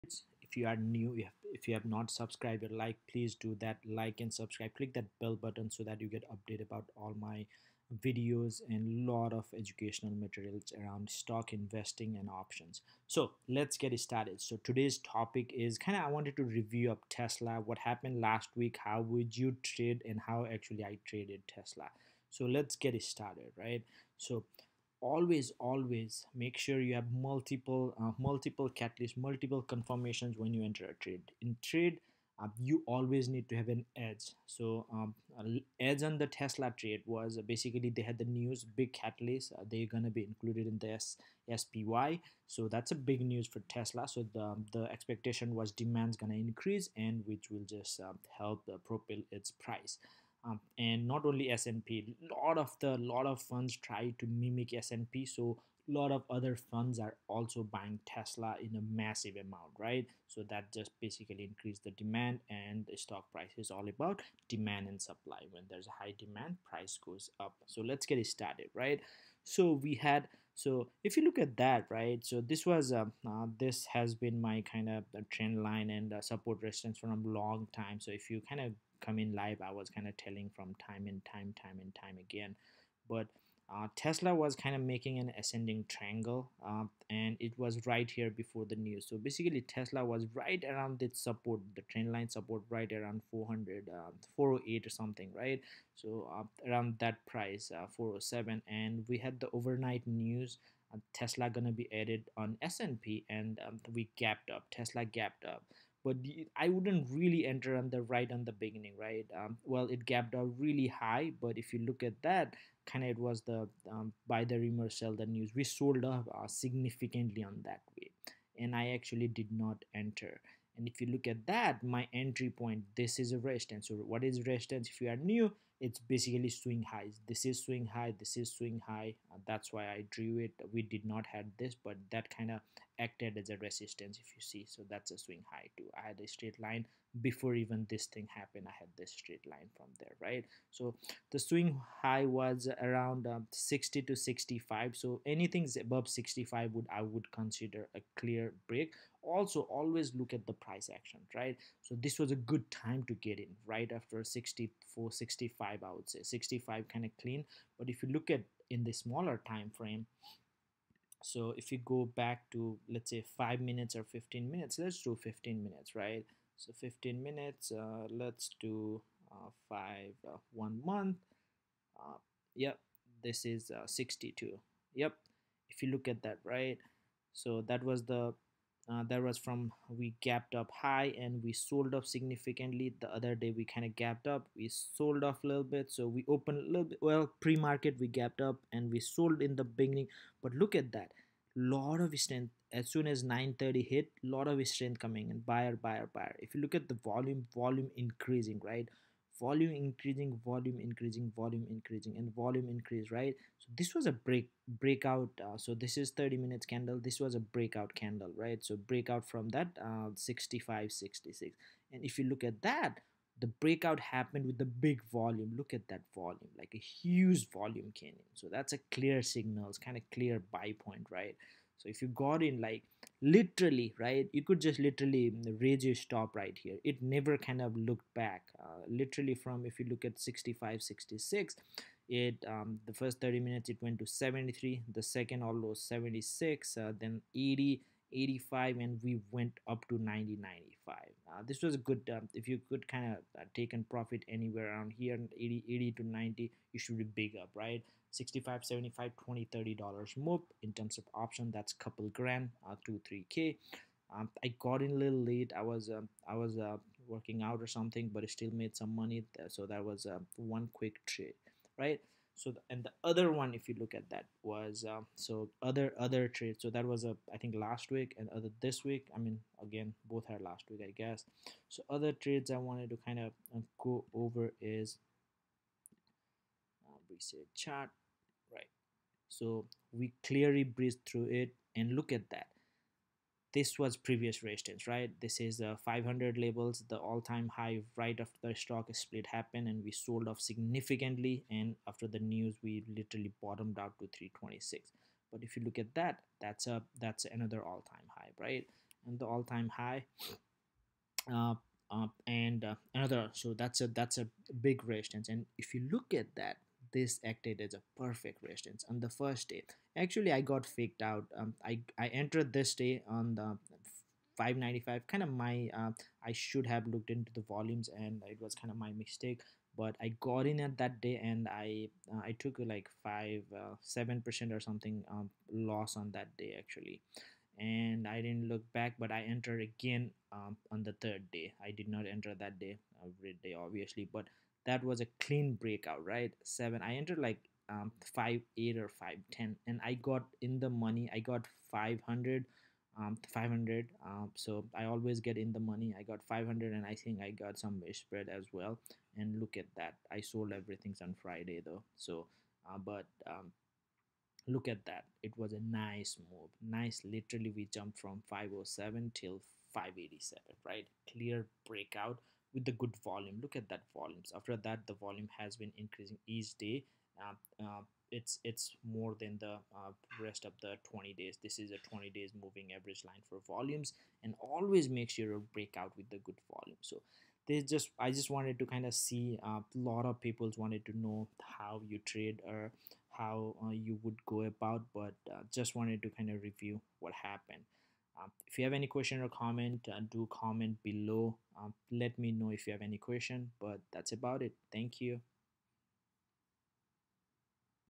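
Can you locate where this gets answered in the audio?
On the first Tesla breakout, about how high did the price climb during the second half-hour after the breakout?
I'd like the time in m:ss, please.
3:55.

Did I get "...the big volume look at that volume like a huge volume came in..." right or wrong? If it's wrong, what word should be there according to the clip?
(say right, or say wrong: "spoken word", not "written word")
right.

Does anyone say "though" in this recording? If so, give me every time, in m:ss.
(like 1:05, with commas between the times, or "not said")
5:51.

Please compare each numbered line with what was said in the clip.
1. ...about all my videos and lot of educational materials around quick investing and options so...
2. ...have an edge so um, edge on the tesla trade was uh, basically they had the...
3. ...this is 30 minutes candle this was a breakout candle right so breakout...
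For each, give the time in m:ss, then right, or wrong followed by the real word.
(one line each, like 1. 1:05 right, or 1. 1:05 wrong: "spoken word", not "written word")
1. 0:06 wrong: "stock", not "quick"
2. 0:33 right
3. 3:25 right.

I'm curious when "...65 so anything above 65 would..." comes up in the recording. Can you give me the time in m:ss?
2:24.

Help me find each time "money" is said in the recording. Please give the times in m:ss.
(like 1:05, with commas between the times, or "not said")
4:18, 5:40, 5:45.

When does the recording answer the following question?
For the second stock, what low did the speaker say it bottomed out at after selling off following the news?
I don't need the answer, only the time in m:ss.
4:54.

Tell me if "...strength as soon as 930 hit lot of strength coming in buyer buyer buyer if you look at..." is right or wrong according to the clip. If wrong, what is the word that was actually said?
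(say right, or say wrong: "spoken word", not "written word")
right.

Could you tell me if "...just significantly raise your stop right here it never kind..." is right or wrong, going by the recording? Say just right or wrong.
wrong.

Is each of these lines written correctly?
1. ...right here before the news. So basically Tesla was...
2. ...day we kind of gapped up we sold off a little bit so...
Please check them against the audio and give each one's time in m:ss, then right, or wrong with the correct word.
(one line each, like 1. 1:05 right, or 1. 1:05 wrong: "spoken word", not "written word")
1. 1:27 right
2. 3:03 right.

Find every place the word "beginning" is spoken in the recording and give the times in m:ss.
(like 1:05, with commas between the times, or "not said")
1:48, 3:09.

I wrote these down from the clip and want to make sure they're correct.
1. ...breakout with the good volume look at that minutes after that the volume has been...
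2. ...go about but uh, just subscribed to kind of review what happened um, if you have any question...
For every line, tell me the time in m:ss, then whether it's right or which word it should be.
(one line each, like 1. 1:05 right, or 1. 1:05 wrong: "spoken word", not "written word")
1. 6:01 wrong: "volumes", not "minutes"
2. 6:24 wrong: "wanted", not "subscribed".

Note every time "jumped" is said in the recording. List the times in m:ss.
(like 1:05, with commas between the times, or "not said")
5:57.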